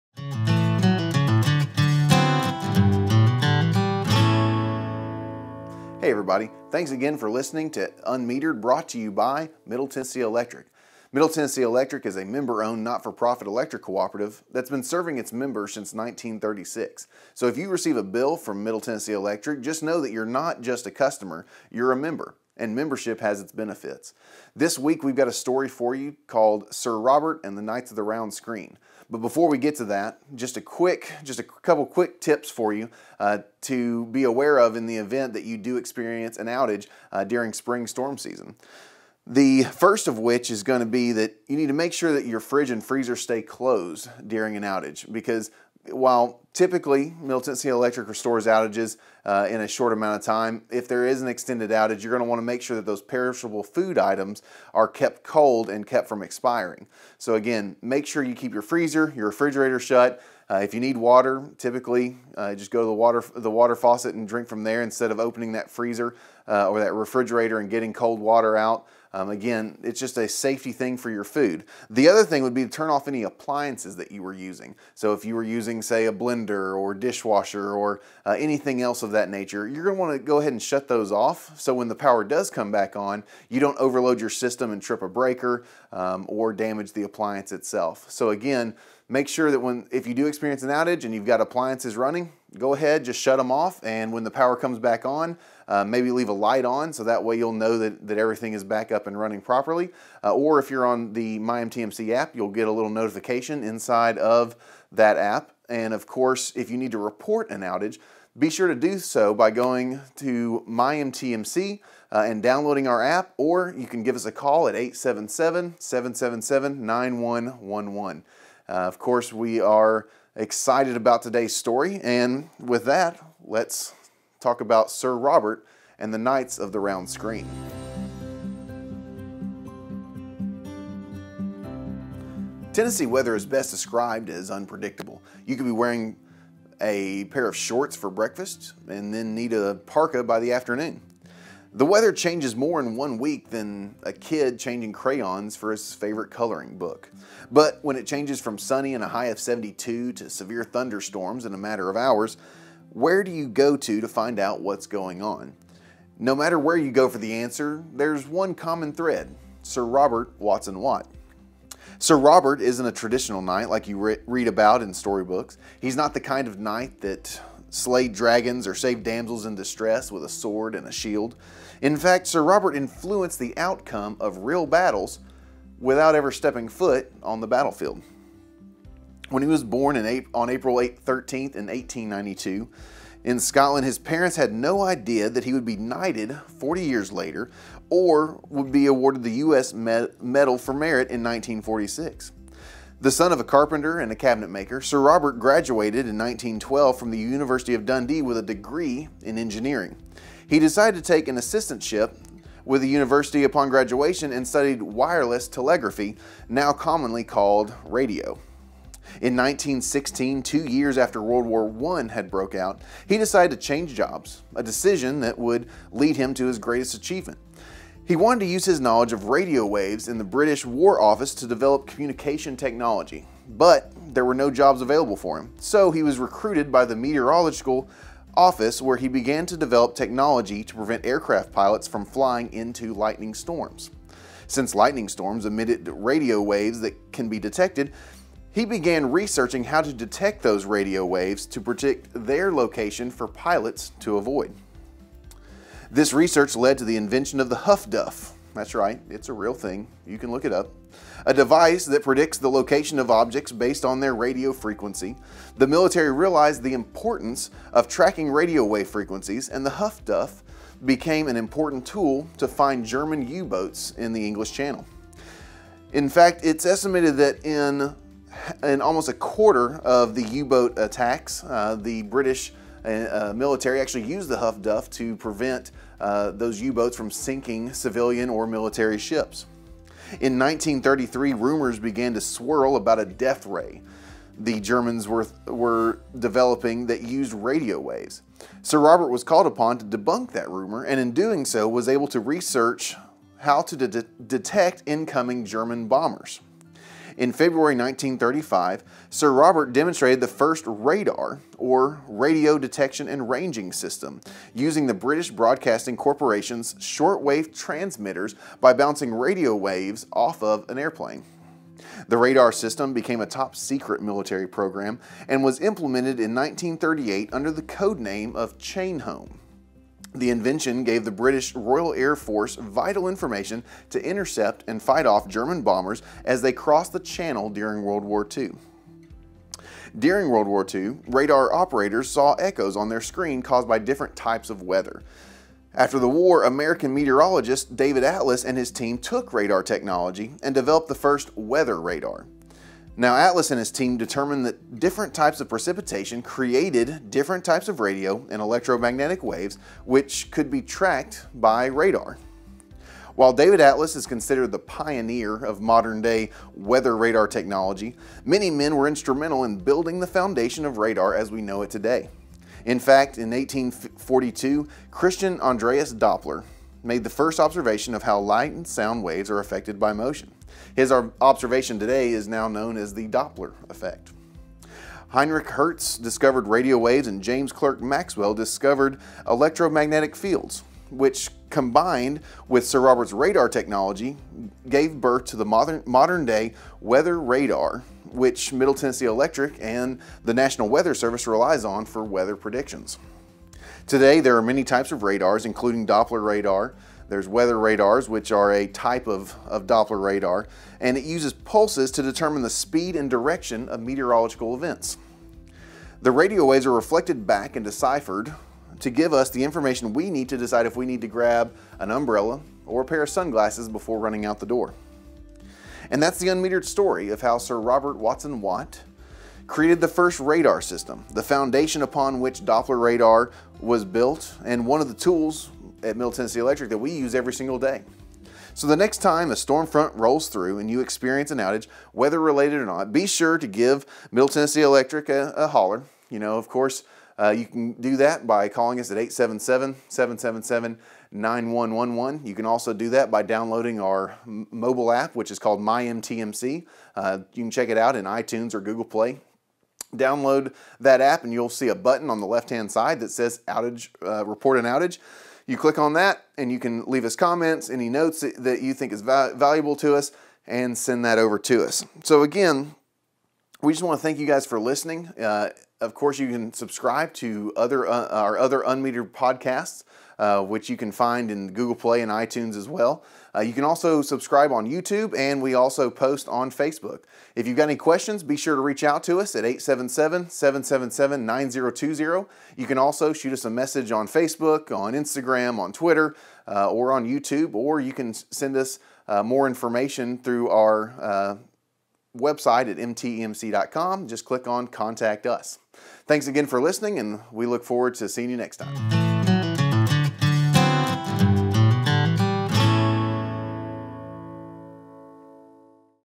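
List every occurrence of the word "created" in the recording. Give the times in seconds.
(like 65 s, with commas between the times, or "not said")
346 s, 419 s.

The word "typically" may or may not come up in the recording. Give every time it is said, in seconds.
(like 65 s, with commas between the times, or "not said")
46 s, 61 s.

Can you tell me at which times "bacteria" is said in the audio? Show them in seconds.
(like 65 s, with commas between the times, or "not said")
not said.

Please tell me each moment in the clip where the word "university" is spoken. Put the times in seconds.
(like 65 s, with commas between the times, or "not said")
197 s, 202 s.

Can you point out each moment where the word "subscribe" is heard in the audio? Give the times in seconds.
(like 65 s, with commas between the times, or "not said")
466 s, 474 s.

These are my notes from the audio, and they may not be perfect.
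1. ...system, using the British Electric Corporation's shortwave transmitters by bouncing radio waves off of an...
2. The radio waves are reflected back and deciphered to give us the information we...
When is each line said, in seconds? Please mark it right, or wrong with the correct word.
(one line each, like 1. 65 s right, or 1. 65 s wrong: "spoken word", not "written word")
1. 303 s wrong: "Broadcasting", not "Electric"
2. 406 s right.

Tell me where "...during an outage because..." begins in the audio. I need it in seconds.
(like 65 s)
44 s.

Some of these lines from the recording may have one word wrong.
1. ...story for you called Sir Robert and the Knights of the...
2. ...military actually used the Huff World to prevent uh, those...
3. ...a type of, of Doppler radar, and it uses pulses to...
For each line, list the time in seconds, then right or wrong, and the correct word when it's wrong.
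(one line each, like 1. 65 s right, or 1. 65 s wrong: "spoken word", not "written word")
1. 25 s right
2. 273 s wrong: "Duff", not "World"
3. 398 s right.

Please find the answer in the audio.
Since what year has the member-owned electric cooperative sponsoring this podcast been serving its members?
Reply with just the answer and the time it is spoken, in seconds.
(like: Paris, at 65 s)
1936, at 15 s.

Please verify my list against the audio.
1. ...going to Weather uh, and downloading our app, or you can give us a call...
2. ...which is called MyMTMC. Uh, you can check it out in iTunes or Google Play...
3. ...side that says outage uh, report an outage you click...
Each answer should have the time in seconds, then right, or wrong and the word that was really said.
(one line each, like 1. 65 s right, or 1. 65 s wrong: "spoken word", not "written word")
1. 109 s wrong: "MyMTMC", not "Weather"
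2. 445 s right
3. 452 s right.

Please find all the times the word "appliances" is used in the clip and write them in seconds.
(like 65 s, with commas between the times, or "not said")
73 s, 87 s, 91 s.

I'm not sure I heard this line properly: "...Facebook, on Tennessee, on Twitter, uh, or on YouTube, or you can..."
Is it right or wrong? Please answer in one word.
wrong.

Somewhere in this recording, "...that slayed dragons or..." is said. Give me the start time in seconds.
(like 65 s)
166 s.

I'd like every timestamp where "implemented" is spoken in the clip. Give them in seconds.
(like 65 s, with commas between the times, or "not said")
315 s.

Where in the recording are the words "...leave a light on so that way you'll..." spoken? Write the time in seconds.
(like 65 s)
96 s.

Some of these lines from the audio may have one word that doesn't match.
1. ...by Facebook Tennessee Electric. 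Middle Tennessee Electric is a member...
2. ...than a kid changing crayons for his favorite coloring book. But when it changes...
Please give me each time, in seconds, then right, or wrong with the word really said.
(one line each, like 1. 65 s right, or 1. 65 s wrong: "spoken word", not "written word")
1. 9 s wrong: "Middle", not "Facebook"
2. 143 s right.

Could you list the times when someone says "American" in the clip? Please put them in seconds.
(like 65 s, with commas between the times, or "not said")
336 s.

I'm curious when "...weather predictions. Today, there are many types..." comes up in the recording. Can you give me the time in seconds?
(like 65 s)
392 s.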